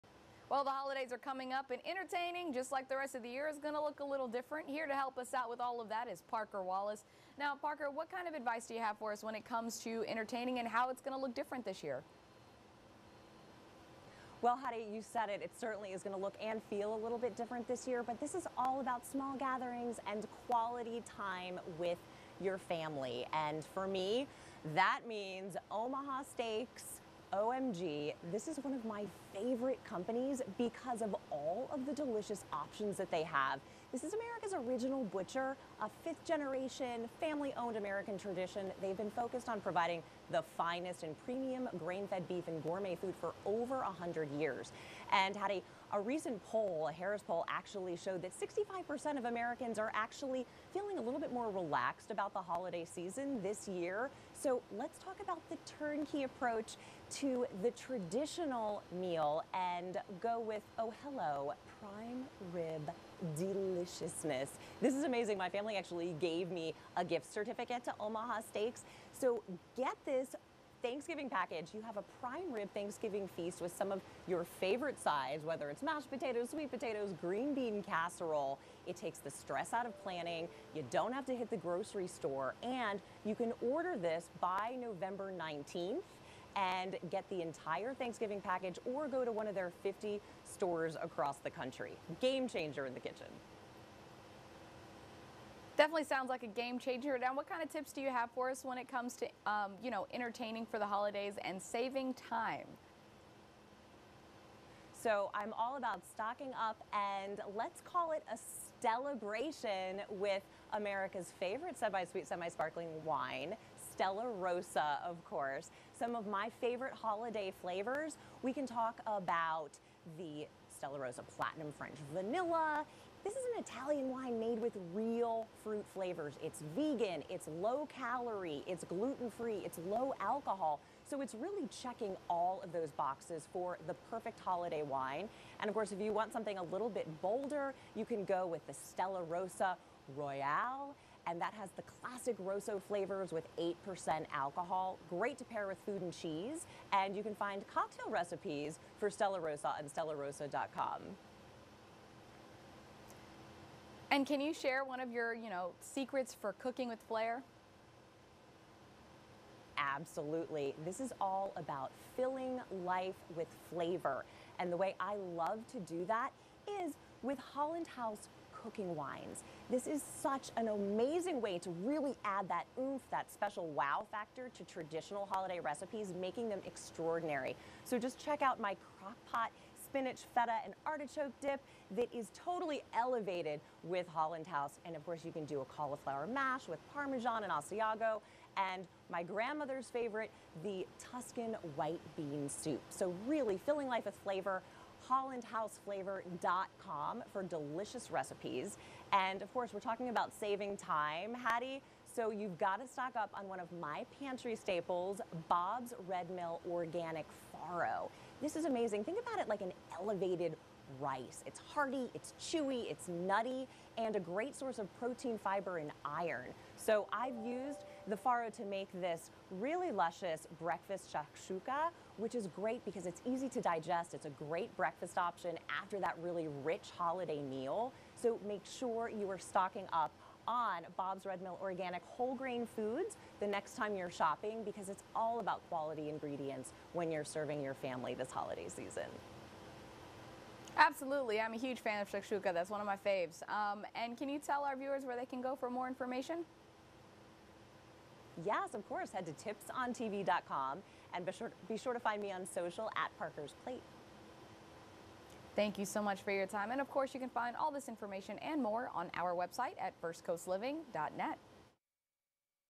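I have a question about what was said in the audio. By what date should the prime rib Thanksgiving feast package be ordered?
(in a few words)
November 19th.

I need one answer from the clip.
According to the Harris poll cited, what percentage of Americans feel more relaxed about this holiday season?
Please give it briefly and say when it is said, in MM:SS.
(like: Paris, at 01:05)
65%, at 00:48.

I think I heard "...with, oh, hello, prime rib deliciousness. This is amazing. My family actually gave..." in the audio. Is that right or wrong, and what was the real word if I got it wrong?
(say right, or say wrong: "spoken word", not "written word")
right.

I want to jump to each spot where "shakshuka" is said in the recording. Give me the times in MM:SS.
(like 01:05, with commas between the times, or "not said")
03:41, 04:02.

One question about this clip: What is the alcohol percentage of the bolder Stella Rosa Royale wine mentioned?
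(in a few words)
8%.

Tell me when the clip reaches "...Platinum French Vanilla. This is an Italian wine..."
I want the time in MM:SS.
02:01.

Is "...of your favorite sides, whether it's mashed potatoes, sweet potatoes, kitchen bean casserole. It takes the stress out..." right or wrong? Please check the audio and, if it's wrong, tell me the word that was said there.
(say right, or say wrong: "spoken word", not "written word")
wrong: "green", not "kitchen".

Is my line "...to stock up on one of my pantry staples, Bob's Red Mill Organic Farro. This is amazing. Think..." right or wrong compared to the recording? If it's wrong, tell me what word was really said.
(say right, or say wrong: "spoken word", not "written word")
right.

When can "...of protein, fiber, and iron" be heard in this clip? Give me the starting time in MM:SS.
03:34.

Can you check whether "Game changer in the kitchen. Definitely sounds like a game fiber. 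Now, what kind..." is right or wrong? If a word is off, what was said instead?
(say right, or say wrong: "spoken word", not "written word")
wrong: "changer", not "fiber".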